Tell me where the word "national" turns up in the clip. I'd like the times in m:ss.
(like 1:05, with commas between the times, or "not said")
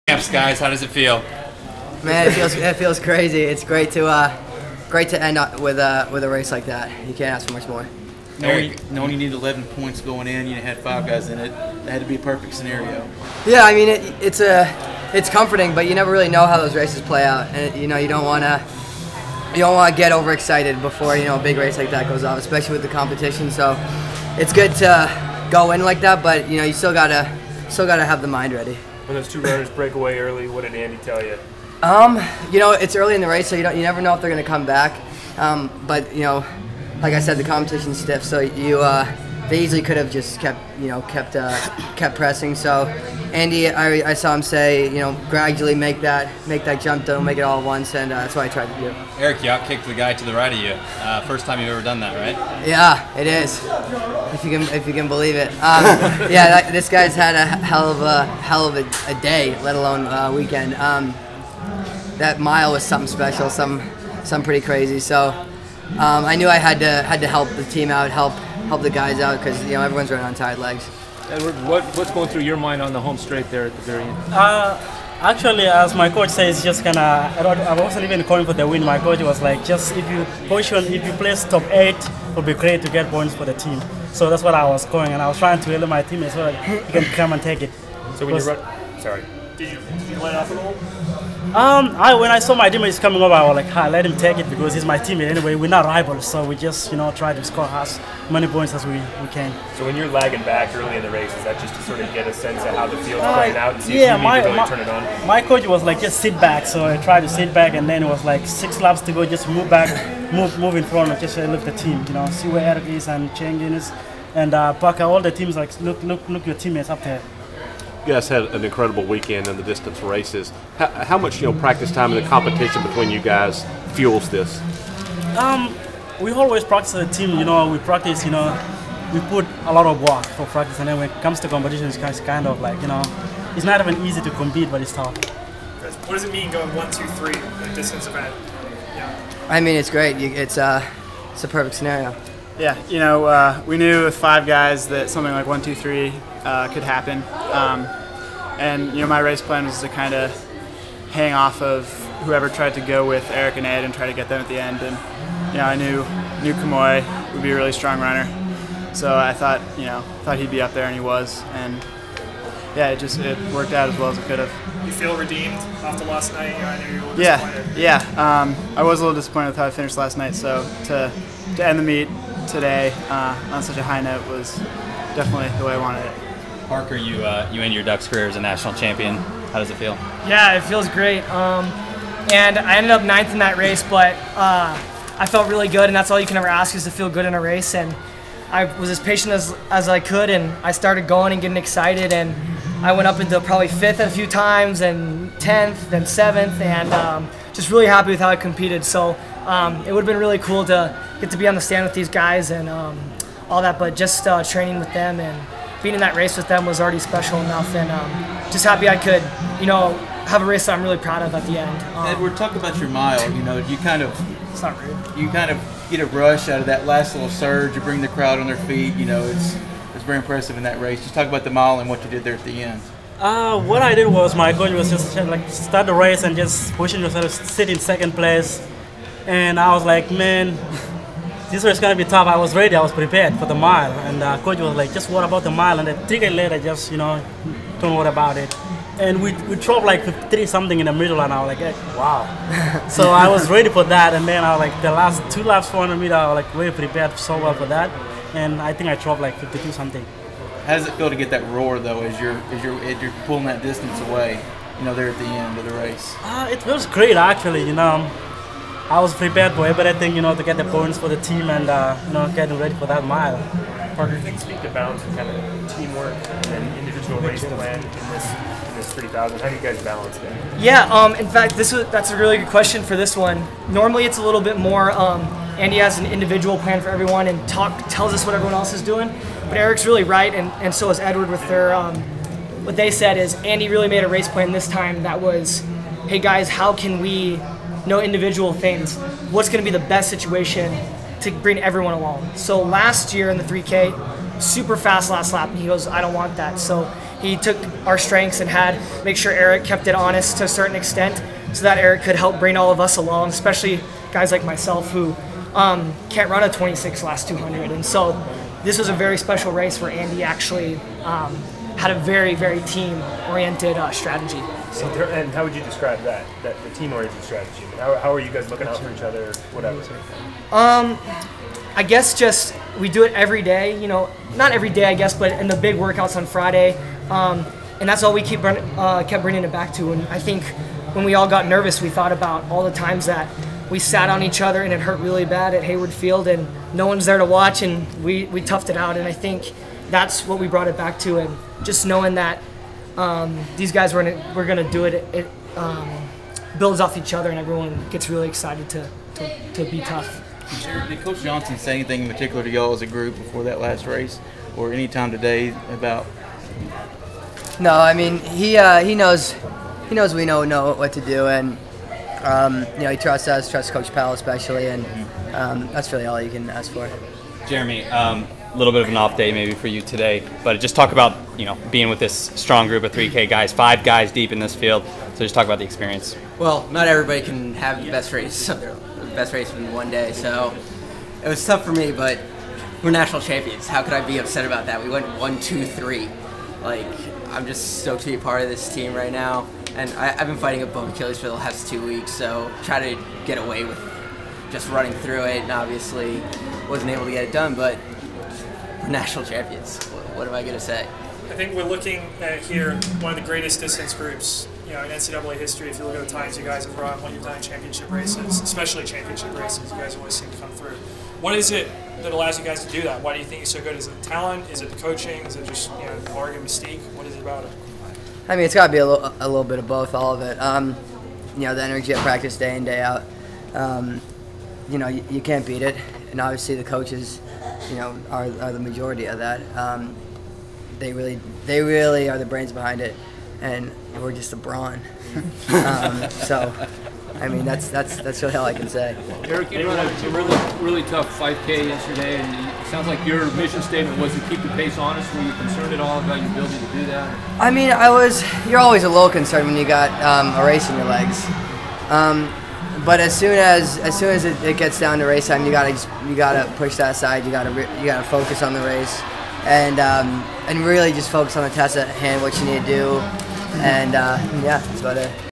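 2:58, 6:22, 6:38.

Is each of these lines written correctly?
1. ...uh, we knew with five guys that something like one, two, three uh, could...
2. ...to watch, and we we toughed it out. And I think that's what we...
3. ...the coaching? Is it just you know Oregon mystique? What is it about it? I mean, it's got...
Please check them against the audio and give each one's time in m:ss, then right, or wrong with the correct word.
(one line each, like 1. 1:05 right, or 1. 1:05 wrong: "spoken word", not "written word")
1. 2:23 right
2. 5:37 right
3. 6:54 right.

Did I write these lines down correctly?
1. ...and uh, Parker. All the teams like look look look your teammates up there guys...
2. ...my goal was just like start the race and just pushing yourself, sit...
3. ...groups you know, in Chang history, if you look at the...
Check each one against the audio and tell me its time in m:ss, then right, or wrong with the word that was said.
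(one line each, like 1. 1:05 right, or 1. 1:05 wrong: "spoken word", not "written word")
1. 1:54 right
2. 3:44 right
3. 6:43 wrong: "NCAA", not "Chang".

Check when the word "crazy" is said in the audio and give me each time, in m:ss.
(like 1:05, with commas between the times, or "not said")
0:02, 1:04.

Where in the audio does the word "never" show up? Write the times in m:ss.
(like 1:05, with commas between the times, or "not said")
0:15, 0:33.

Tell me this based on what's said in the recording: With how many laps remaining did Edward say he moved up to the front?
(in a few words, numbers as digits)
six.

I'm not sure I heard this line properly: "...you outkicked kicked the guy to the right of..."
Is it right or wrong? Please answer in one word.
right.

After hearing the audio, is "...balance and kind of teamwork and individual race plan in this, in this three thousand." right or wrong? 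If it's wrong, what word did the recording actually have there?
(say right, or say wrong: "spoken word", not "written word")
right.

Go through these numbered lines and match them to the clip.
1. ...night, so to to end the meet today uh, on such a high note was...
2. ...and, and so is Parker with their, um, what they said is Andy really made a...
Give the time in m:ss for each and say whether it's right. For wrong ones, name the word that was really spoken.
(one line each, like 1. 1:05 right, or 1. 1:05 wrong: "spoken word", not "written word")
1. 2:50 right
2. 4:40 wrong: "Edward", not "Parker".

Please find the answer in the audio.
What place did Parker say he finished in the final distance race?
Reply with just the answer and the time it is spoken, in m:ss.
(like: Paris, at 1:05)
ninth, at 3:03.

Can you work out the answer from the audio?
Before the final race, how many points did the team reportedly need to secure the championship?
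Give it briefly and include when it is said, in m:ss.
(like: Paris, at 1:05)
11, at 0:09.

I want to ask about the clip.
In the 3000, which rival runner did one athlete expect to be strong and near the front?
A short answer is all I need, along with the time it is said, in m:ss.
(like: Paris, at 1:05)
Kemoy, at 2:36.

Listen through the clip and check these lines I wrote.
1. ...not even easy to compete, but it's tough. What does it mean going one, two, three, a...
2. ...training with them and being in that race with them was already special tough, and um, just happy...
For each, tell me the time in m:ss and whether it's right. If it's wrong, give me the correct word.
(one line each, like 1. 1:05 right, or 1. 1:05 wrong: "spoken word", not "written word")
1. 2:13 right
2. 3:24 wrong: "enough", not "tough".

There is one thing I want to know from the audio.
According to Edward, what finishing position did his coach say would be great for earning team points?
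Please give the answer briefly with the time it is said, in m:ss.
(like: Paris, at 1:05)
top eight, at 1:21.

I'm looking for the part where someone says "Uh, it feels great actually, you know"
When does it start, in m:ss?
4:16.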